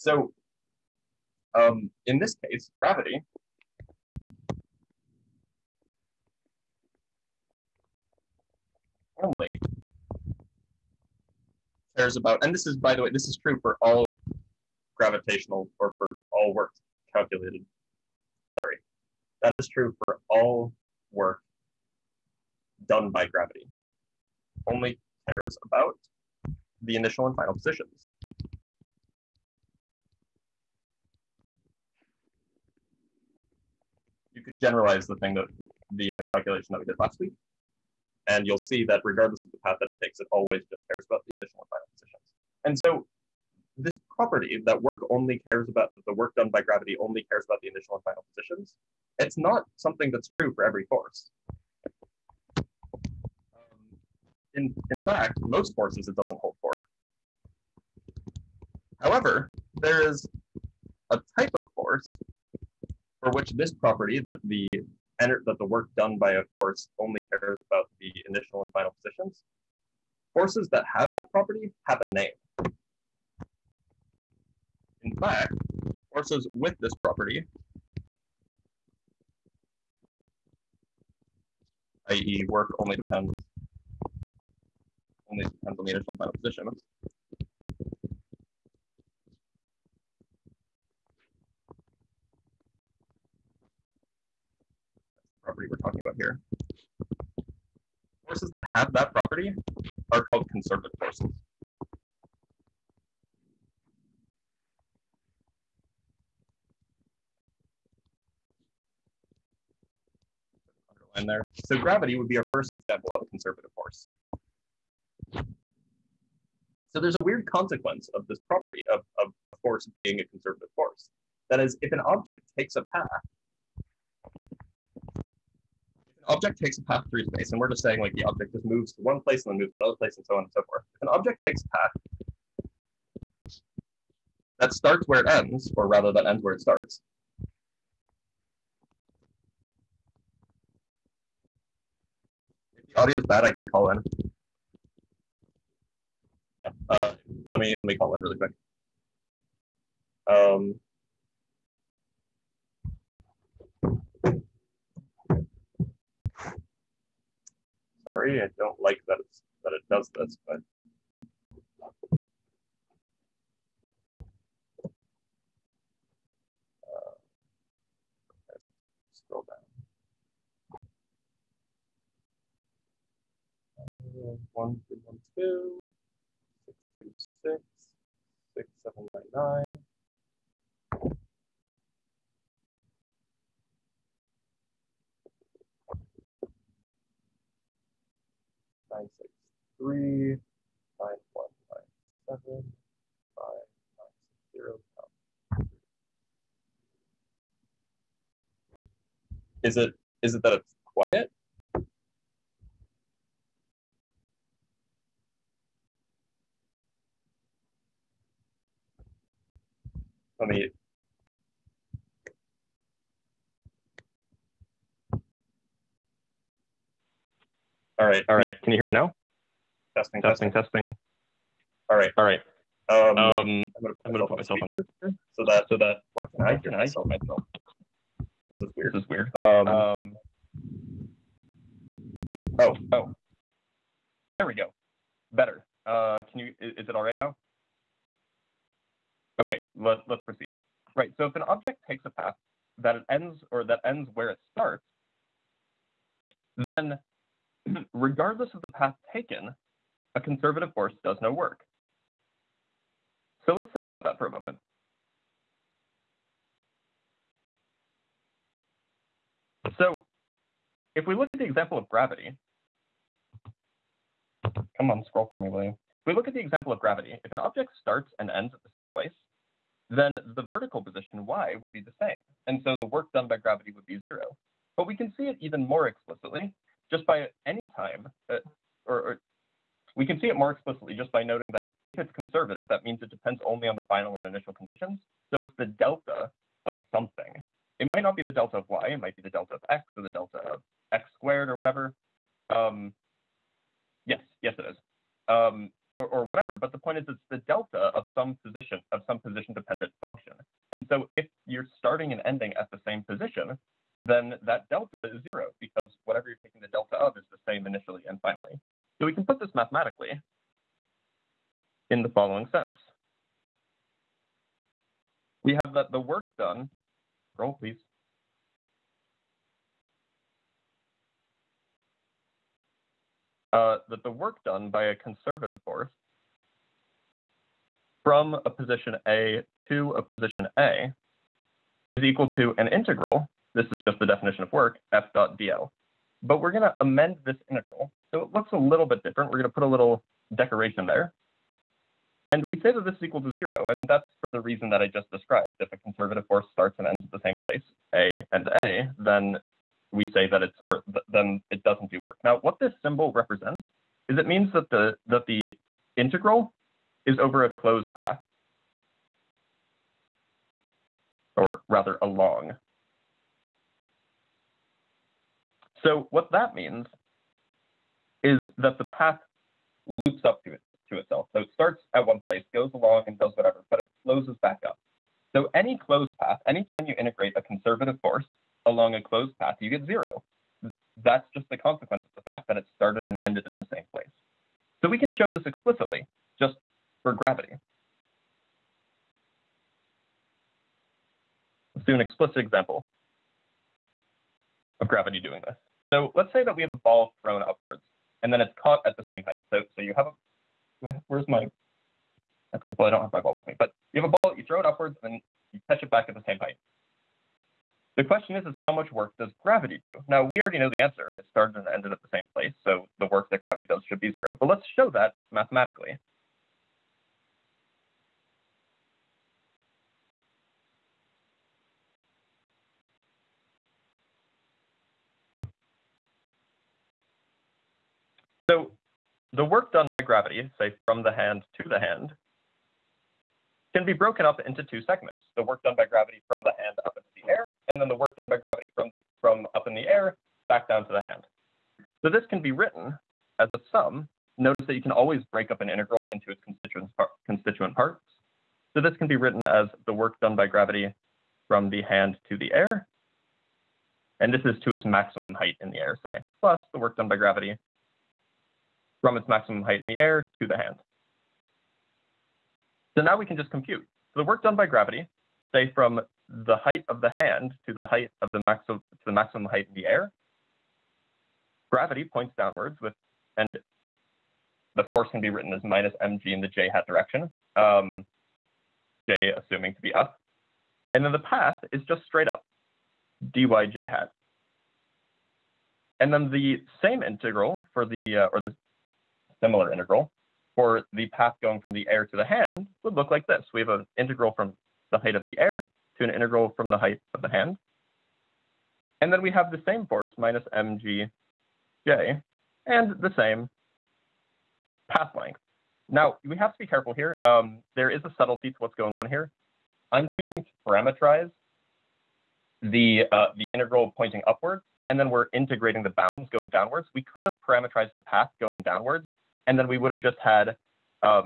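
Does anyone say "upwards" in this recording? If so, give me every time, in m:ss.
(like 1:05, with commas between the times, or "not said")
6:37, 6:44, 8:34.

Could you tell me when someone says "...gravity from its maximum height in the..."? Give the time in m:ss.
7:37.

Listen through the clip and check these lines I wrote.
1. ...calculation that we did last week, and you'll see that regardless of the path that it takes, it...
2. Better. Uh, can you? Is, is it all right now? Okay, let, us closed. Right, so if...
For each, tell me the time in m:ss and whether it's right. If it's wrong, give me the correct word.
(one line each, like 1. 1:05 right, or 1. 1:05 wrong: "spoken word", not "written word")
1. 0:36 right
2. 3:55 wrong: "proceed", not "closed".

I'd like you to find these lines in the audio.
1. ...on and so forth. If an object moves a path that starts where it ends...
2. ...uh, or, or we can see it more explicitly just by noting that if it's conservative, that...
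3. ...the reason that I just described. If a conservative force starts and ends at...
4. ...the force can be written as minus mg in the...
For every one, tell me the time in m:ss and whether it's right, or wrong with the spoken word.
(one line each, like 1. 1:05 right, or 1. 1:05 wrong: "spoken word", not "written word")
1. 2:10 wrong: "takes", not "moves"
2. 4:38 right
3. 5:44 right
4. 7:54 right.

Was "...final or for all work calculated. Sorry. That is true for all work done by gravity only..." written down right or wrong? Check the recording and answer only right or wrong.
wrong.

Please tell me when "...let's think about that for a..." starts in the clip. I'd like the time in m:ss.
4:13.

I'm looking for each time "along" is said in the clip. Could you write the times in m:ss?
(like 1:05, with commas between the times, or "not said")
6:02, 6:12, 6:18.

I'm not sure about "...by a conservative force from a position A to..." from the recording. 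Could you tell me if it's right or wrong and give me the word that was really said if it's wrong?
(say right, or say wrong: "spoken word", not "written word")
right.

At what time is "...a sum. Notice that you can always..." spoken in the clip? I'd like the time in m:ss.
7:23.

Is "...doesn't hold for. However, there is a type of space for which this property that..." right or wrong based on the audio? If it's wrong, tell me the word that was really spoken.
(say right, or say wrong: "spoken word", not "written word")
wrong: "force", not "space".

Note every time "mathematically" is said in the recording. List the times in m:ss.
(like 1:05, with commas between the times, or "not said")
5:09, 6:55.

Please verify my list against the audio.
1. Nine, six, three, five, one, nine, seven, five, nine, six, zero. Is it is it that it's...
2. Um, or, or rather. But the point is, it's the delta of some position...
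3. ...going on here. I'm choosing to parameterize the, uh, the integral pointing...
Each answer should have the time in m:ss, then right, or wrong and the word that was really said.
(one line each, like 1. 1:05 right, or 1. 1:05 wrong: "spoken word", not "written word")
1. 3:08 wrong: "nine", not "five"
2. 4:55 wrong: "whatever", not "rather"
3. 8:28 right.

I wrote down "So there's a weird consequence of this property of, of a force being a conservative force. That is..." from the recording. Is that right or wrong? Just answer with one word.
right.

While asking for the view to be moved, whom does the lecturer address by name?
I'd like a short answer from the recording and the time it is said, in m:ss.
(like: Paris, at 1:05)
William, at 4:25.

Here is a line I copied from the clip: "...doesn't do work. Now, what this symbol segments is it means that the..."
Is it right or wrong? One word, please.
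wrong.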